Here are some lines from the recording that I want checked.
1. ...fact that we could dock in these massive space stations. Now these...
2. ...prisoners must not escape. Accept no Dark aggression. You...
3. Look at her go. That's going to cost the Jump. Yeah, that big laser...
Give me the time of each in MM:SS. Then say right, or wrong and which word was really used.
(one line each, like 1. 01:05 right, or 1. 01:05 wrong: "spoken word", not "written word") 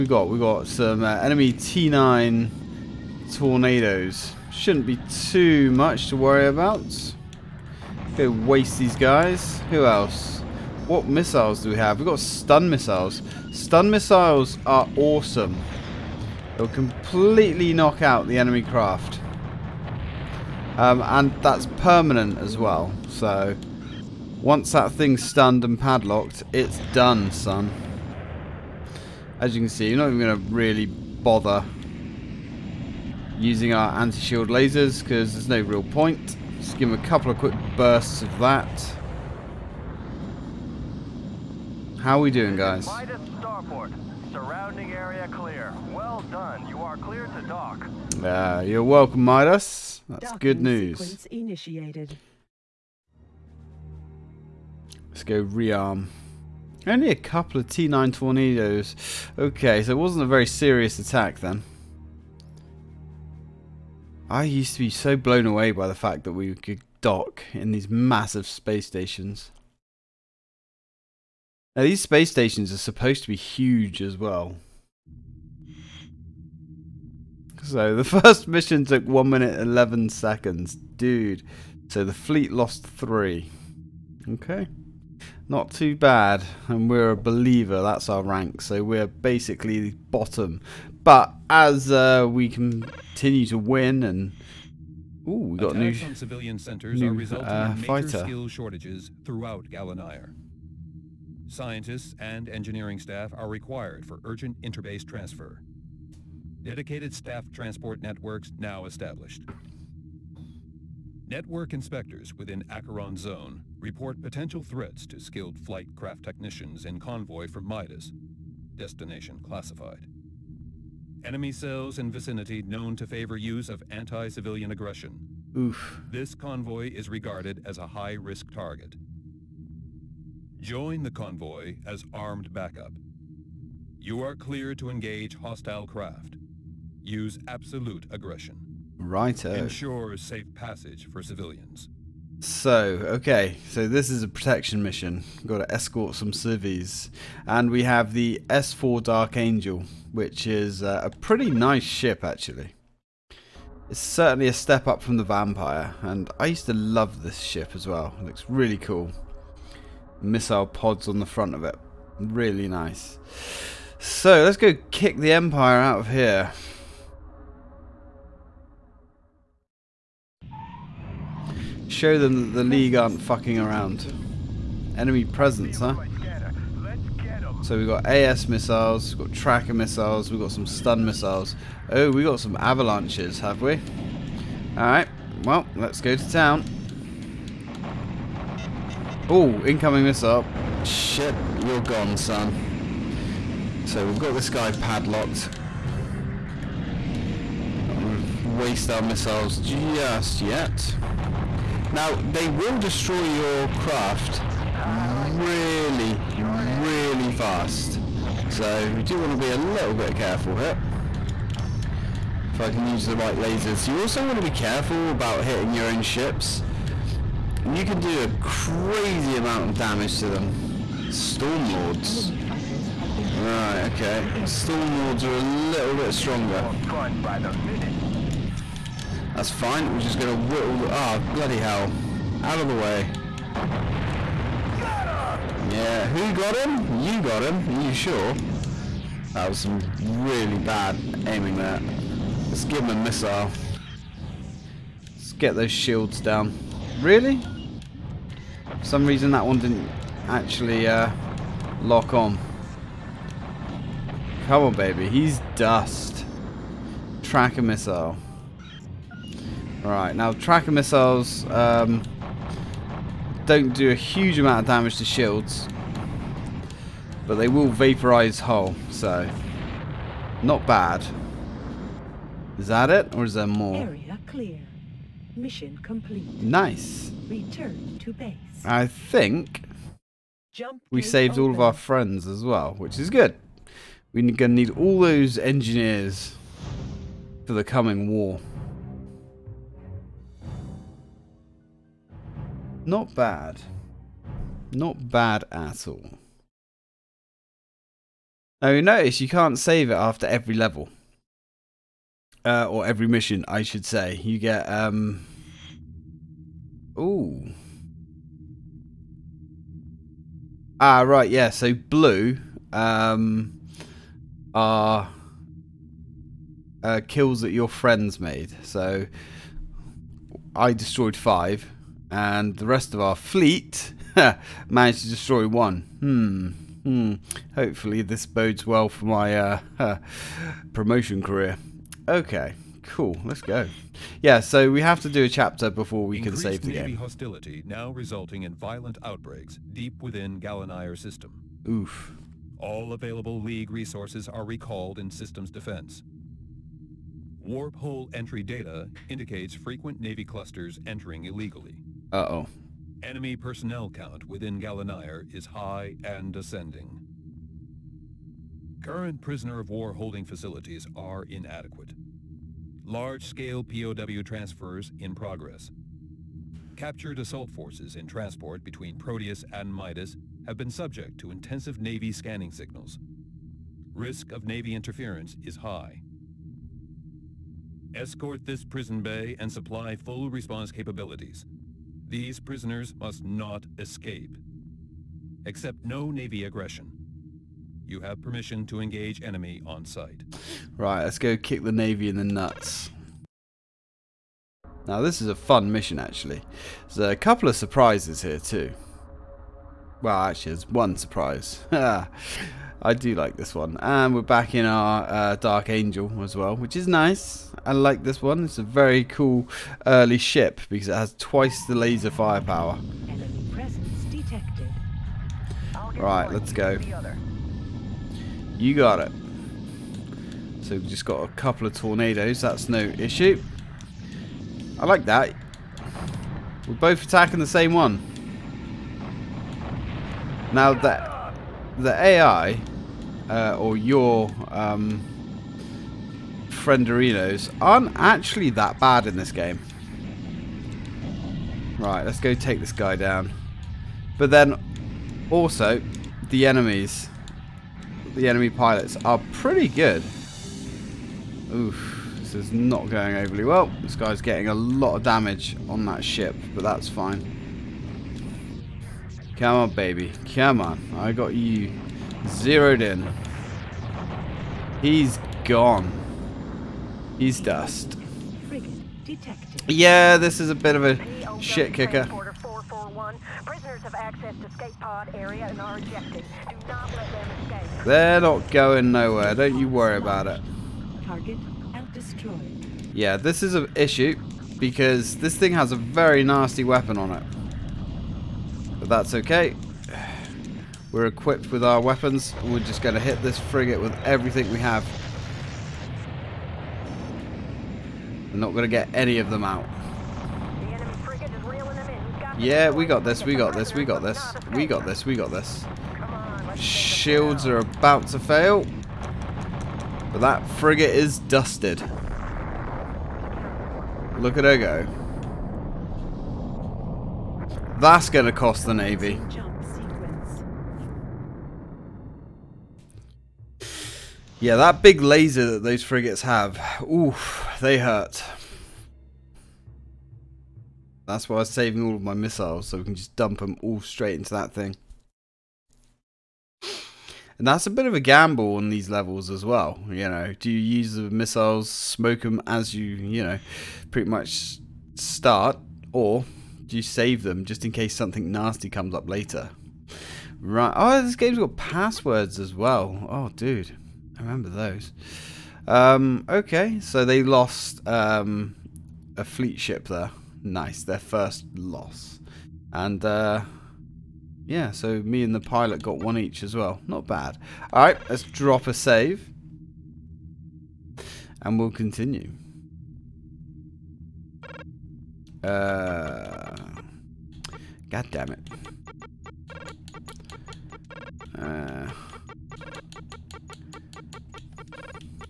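1. 01:05 right
2. 06:22 wrong: "Navy", not "Dark"
3. 08:34 wrong: "Navy", not "Jump".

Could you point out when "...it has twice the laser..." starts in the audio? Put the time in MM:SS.
06:50.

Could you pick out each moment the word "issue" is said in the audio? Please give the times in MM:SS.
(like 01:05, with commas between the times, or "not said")
07:02, 08:03.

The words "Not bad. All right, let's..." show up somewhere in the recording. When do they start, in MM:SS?
09:26.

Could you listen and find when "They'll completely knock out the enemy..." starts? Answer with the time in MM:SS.
00:16.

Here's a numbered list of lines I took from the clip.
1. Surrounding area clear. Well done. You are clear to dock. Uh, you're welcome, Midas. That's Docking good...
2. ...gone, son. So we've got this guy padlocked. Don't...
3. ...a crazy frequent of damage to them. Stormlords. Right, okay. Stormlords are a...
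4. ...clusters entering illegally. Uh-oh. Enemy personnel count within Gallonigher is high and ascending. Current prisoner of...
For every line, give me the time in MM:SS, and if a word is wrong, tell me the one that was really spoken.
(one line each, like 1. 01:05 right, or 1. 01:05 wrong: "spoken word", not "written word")
1. 00:44 right
2. 03:11 right
3. 03:38 wrong: "amount", not "frequent"
4. 05:50 right.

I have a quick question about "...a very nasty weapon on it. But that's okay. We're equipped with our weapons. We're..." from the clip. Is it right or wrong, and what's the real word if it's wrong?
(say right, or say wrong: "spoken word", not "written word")
right.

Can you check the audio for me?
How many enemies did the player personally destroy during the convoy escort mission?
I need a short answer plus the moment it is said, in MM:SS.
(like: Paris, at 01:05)
5, at 05:21.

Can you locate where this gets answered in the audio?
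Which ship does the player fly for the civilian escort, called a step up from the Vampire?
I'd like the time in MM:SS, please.
02:28.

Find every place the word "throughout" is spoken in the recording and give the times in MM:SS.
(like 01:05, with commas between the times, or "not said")
01:39.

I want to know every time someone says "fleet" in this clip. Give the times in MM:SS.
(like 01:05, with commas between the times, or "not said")
01:22, 05:23, 09:19.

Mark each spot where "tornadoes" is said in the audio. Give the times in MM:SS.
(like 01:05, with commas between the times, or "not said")
00:03, 00:58, 07:01.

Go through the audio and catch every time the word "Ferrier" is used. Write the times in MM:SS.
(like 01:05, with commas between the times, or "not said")
not said.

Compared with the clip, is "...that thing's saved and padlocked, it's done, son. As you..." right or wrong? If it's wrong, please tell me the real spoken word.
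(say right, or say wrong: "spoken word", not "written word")
wrong: "stunned", not "saved".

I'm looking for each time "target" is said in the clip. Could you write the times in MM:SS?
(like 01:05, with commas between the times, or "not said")
02:08, 08:01.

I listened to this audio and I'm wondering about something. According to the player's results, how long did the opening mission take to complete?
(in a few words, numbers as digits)
1 minute 11 seconds.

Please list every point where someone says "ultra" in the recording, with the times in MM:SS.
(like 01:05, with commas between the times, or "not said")
not said.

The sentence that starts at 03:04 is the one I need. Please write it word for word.
Alright, well, let's go to town.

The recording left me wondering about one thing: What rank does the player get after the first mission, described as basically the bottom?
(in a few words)
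Believer.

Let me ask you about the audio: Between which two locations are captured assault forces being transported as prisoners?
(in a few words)
Proteus and Midas.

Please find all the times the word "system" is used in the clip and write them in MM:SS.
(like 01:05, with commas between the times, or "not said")
05:40, 05:45.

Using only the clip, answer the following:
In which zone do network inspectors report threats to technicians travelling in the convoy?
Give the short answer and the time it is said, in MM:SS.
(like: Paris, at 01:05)
Acheron Zone, at 01:52.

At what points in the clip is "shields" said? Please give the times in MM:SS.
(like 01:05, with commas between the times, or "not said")
00:33, 04:05, 04:25, 08:26.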